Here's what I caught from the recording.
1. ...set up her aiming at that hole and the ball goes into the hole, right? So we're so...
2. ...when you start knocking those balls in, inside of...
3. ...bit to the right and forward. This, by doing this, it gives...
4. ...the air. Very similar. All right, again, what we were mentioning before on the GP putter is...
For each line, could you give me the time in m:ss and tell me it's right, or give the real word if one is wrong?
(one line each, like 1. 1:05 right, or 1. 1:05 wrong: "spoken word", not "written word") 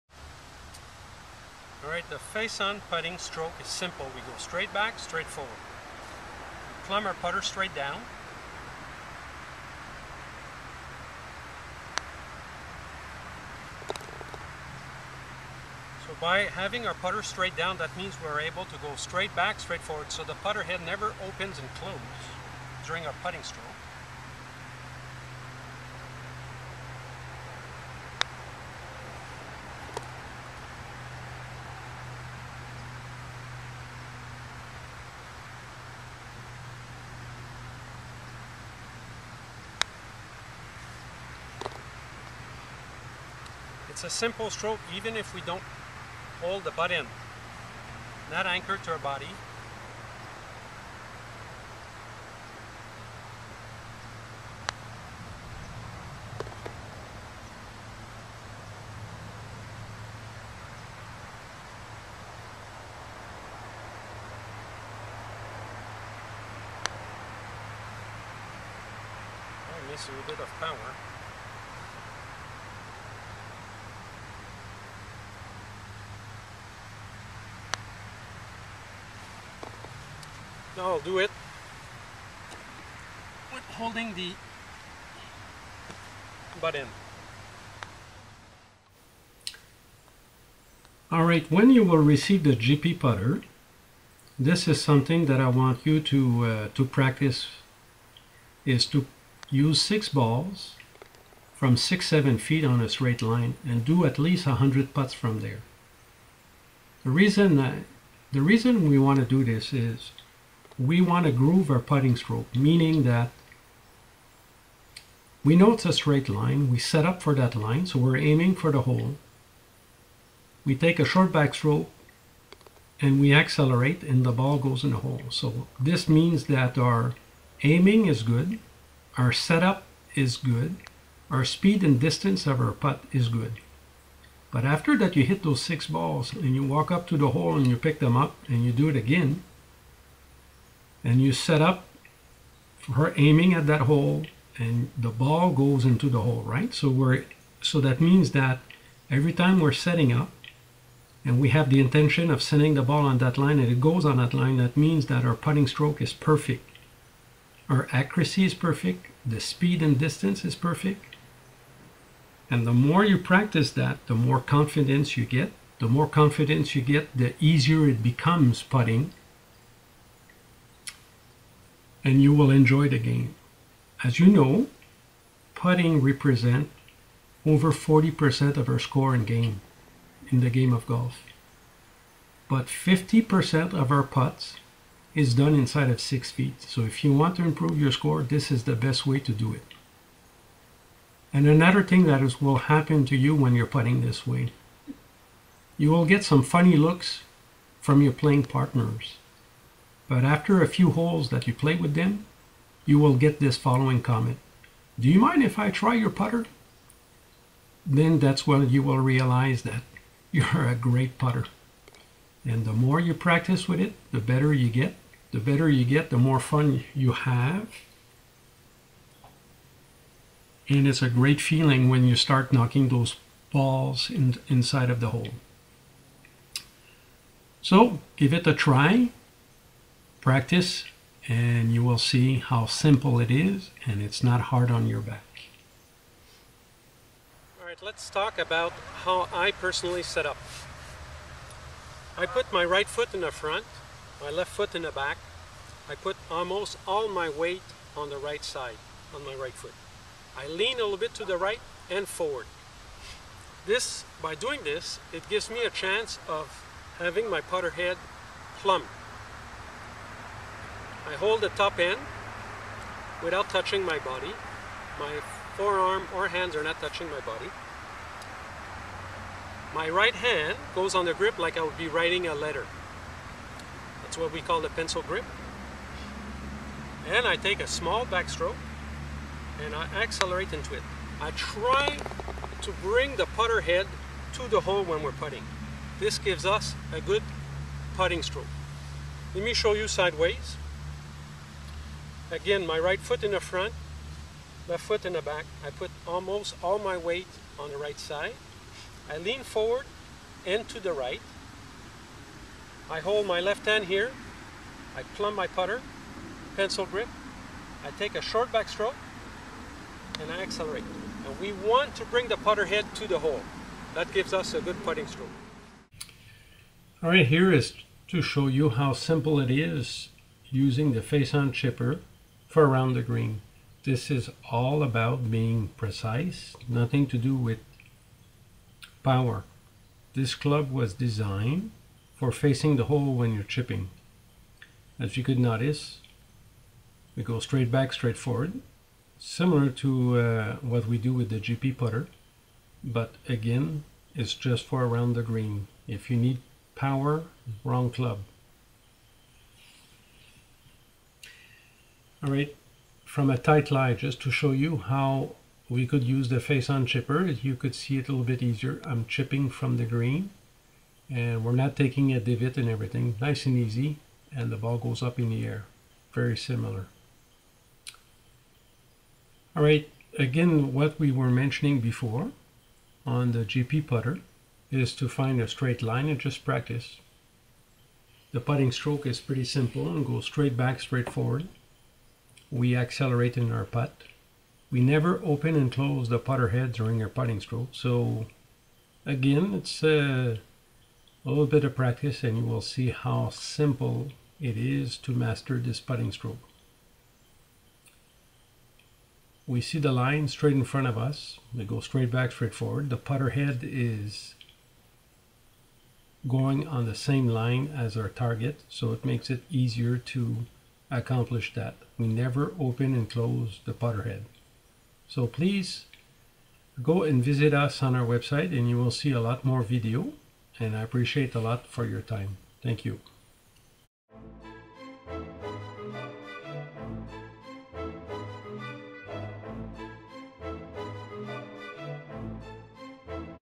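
1. 2:21 right
2. 3:41 right
3. 4:10 right
4. 6:05 right.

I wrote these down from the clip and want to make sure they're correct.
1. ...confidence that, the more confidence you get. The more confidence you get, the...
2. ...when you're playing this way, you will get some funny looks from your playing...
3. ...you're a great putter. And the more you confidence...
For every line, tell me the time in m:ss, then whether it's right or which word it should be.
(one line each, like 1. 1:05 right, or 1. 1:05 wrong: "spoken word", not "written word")
1. 2:43 wrong: "practice", not "confidence"
2. 3:13 wrong: "putting", not "playing"
3. 3:30 wrong: "practice", not "confidence".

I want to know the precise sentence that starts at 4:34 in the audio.
That's what we call the pencil grip.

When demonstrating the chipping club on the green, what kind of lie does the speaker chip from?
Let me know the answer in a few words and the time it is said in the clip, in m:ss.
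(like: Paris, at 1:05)
tight lie, at 5:53.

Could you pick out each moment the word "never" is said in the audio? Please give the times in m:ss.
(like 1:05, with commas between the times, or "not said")
0:20, 6:24, 6:52.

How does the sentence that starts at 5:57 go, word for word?
You could see it a little bit easier.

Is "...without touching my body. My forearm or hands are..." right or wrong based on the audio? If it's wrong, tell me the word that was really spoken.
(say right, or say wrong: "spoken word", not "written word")
right.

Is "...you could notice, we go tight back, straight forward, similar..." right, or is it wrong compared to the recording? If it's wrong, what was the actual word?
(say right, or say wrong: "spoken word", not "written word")
wrong: "straight", not "tight".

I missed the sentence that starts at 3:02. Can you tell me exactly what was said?
But 50% of our putts is done inside of six feet.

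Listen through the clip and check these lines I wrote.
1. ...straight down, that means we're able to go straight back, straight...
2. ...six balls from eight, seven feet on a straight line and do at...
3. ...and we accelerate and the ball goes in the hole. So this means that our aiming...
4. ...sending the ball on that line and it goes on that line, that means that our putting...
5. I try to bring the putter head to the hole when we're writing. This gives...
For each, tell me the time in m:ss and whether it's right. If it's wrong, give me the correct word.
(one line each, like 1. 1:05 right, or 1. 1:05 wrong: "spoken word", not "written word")
1. 0:17 right
2. 1:39 wrong: "six", not "eight"
3. 2:02 right
4. 2:32 right
5. 4:41 wrong: "putting", not "writing".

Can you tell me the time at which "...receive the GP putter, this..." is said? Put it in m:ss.
1:31.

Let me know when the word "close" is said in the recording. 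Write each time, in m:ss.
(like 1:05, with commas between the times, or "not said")
0:21, 6:25, 6:53.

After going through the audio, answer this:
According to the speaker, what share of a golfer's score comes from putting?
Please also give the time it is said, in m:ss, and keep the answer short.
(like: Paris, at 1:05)
over 40%, at 2:57.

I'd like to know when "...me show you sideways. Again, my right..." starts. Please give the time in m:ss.
4:49.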